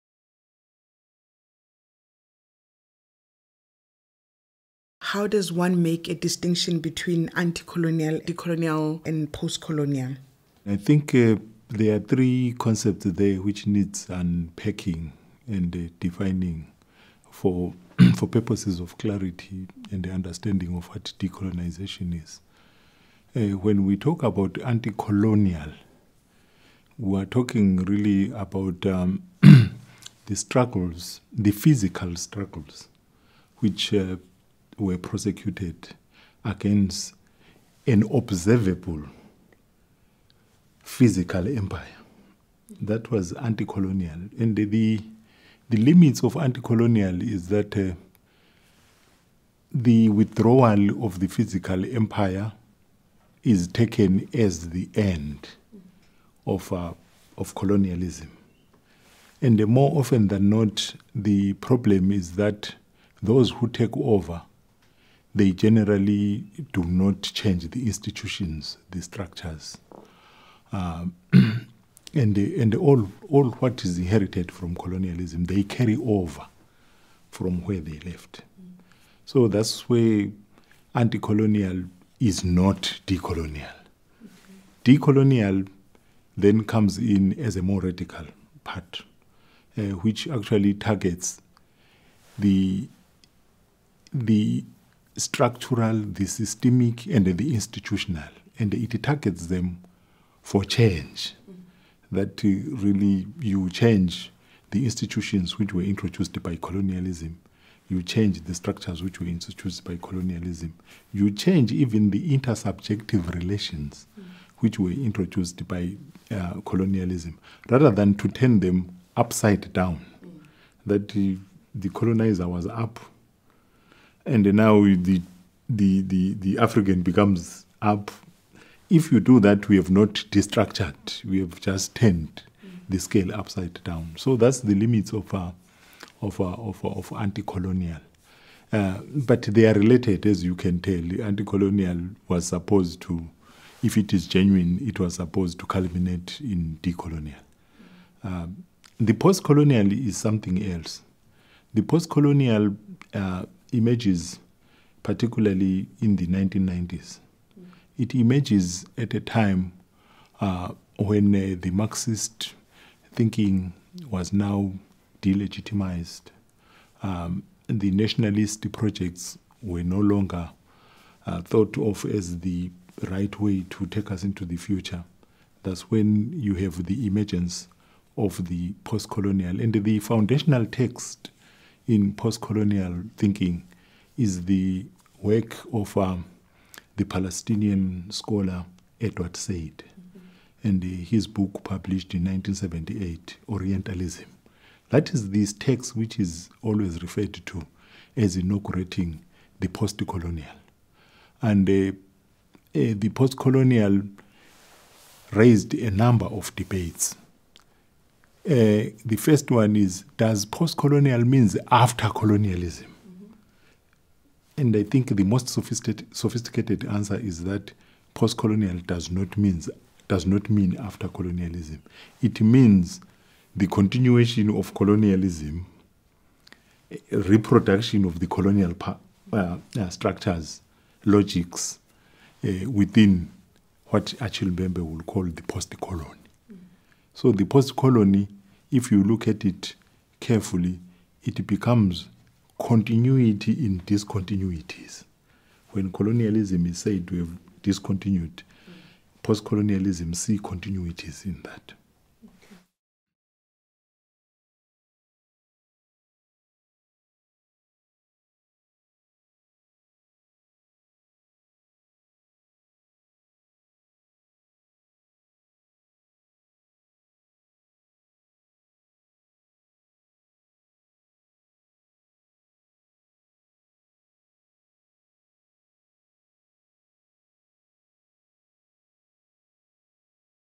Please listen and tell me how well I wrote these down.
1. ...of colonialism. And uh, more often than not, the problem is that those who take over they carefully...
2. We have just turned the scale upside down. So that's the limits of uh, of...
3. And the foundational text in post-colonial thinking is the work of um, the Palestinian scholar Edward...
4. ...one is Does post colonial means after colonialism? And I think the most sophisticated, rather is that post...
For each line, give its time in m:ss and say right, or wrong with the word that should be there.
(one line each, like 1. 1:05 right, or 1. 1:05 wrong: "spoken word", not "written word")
1. 0:57 wrong: "generally", not "carefully"
2. 2:11 right
3. 2:59 right
4. 3:29 wrong: "answer", not "rather".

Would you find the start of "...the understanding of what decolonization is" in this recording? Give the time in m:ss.
0:20.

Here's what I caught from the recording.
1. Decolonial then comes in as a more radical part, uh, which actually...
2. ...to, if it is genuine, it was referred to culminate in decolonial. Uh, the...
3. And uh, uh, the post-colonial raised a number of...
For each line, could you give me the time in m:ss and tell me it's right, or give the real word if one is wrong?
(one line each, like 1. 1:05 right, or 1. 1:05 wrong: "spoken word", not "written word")
1. 1:24 right
2. 2:23 wrong: "supposed", not "referred"
3. 3:21 right.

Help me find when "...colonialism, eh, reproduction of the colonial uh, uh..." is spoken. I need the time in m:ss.
3:44.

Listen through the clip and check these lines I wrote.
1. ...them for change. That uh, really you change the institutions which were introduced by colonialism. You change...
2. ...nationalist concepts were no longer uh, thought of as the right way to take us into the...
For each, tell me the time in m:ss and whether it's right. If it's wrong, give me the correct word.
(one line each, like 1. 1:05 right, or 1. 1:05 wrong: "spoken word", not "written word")
1. 1:39 right
2. 2:47 wrong: "projects", not "concepts".